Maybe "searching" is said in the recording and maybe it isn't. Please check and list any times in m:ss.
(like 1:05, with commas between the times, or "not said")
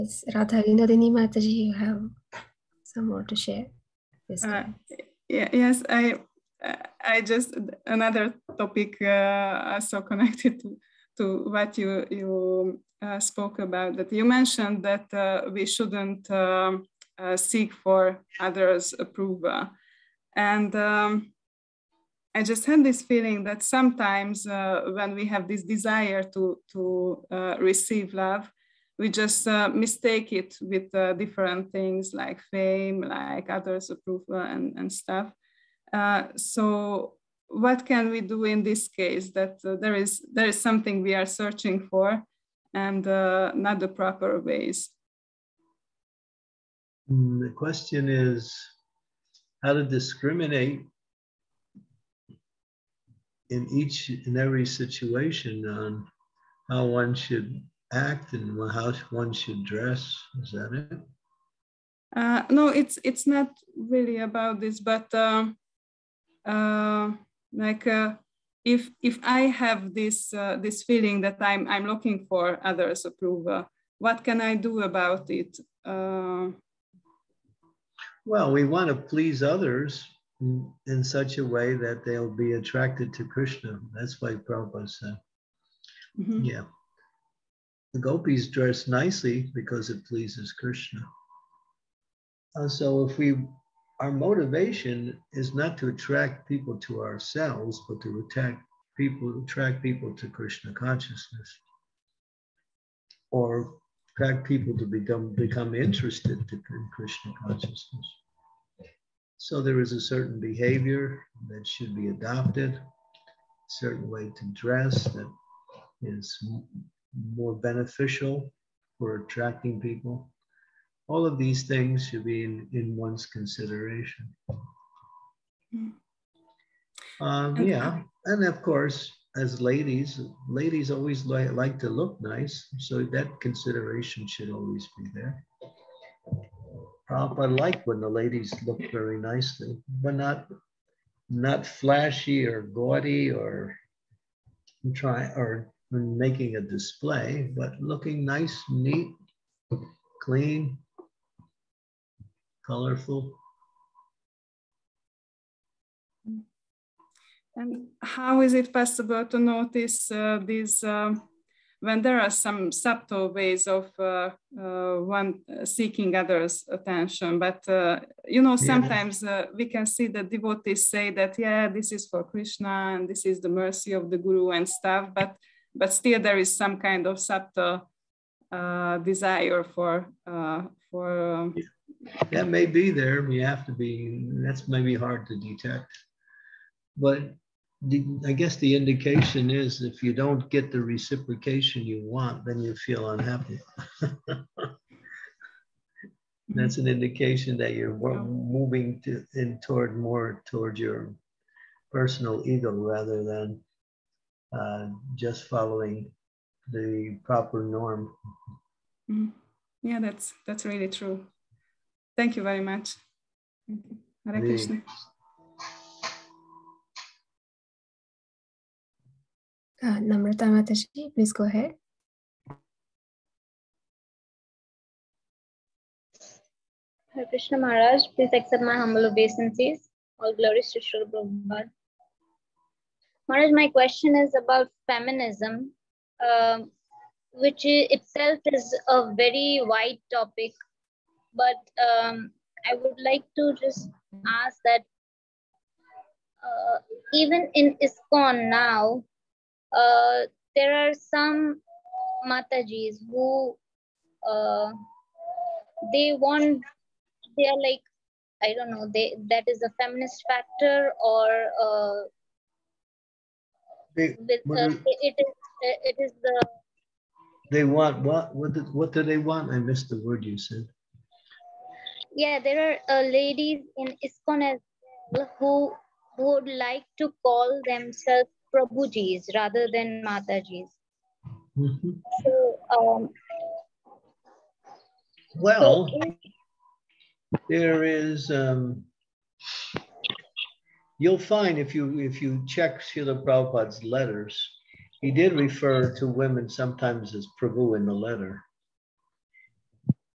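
0:41.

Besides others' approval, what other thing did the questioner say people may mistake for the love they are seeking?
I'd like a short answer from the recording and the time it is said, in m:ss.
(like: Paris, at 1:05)
Fame, at 0:32.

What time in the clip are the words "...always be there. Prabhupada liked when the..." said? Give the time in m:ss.
2:14.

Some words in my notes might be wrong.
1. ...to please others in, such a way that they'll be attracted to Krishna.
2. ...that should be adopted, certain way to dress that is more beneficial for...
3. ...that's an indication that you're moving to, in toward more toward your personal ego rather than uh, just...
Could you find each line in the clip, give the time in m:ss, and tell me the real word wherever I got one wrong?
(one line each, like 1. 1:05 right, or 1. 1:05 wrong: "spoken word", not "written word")
1. 1:18 right
2. 1:51 right
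3. 3:16 right.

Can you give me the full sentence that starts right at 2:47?
But uh, you know, sometimes yeah.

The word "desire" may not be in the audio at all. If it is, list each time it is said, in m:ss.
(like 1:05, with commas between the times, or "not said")
0:25, 2:59.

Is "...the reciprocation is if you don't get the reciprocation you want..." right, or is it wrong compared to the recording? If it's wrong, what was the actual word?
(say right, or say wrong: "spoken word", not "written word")
wrong: "indication", not "reciprocation".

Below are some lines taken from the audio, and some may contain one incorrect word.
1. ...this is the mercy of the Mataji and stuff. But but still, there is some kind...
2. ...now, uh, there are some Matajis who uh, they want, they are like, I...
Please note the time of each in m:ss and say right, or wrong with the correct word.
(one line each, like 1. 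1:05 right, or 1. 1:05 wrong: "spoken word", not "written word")
1. 2:53 wrong: "Guru", not "Mataji"
2. 4:08 right.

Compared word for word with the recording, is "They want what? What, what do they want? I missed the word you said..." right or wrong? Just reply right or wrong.
right.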